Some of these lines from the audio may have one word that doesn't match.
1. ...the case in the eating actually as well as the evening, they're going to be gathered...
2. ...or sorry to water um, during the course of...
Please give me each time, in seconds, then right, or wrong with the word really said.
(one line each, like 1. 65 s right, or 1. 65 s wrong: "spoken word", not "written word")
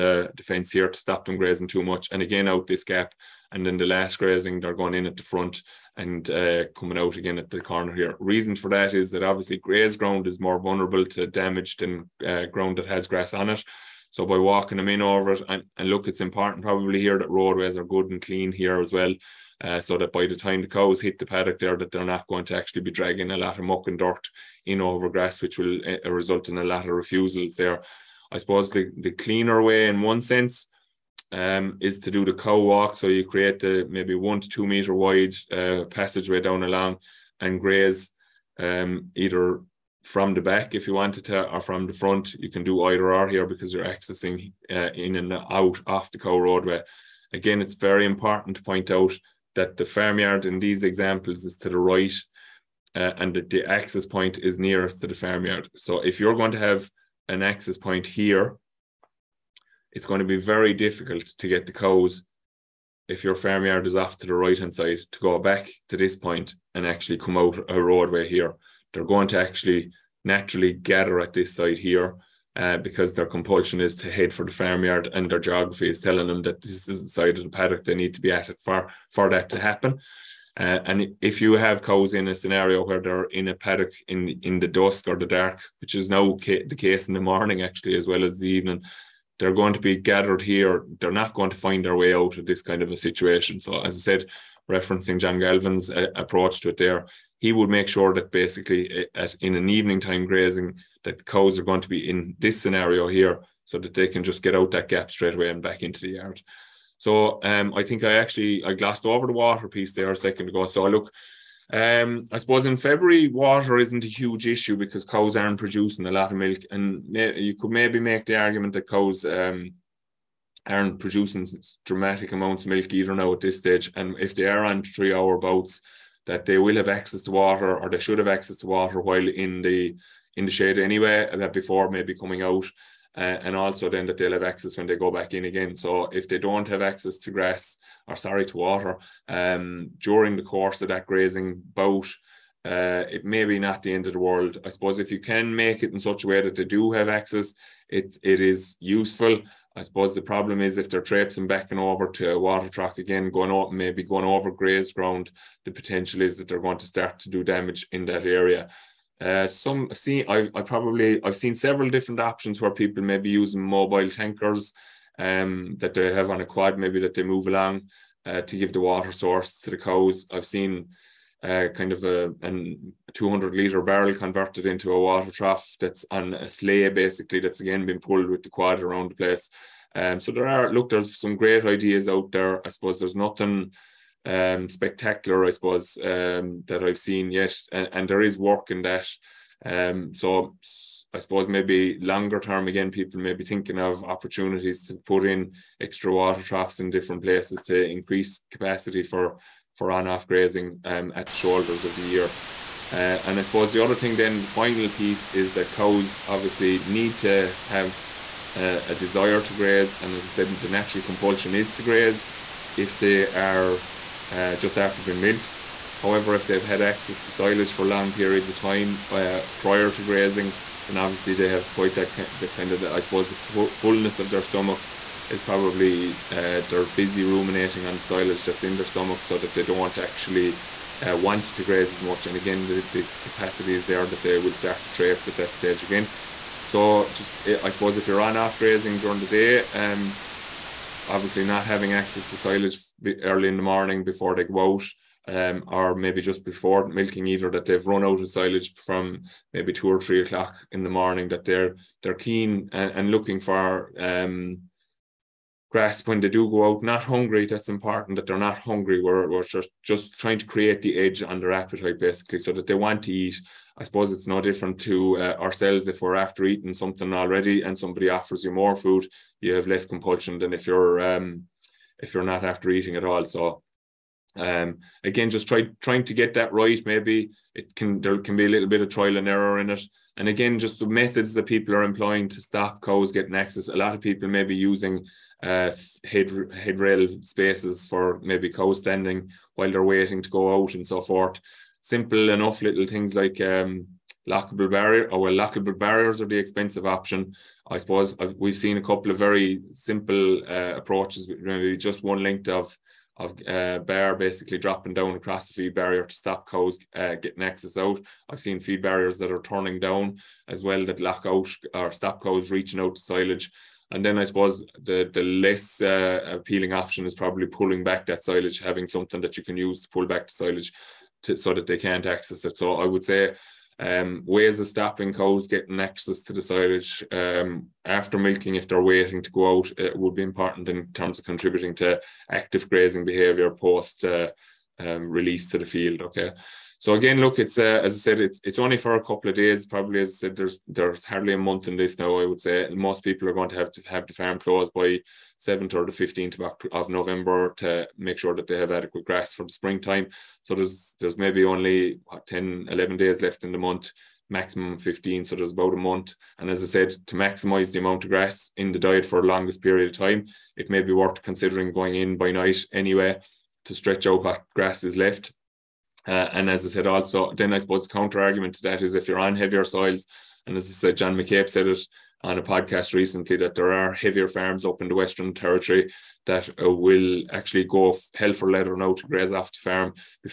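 1. 86 s wrong: "morning", not "eating"
2. 138 s right.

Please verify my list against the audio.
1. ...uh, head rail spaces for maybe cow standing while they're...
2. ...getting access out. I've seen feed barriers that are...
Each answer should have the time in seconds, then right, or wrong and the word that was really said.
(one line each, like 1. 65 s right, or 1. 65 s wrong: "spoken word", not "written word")
1. 285 s right
2. 307 s right.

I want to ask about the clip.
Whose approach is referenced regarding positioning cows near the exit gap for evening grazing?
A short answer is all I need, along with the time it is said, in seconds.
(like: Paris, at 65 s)
John Galvin, at 95 s.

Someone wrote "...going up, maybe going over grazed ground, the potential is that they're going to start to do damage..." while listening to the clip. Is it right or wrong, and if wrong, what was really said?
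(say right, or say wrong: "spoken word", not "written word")
right.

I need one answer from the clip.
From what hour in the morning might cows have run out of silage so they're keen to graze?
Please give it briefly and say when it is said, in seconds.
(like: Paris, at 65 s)
2 or 3 o'clock, at 249 s.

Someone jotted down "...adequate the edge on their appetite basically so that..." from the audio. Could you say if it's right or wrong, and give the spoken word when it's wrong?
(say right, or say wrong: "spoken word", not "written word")
wrong: "create", not "adequate".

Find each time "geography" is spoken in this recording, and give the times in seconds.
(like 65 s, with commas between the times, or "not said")
75 s.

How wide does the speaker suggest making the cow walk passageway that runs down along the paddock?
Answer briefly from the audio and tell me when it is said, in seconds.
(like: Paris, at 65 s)
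1 to 2 meters, at 34 s.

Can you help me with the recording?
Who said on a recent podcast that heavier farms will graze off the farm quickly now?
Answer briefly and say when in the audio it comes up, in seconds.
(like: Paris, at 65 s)
John McCabe, at 370 s.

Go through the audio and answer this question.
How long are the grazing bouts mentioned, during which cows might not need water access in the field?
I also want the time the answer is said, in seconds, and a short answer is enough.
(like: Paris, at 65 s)
3 hours, at 124 s.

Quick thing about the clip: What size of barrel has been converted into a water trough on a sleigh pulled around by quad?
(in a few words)
200 litre.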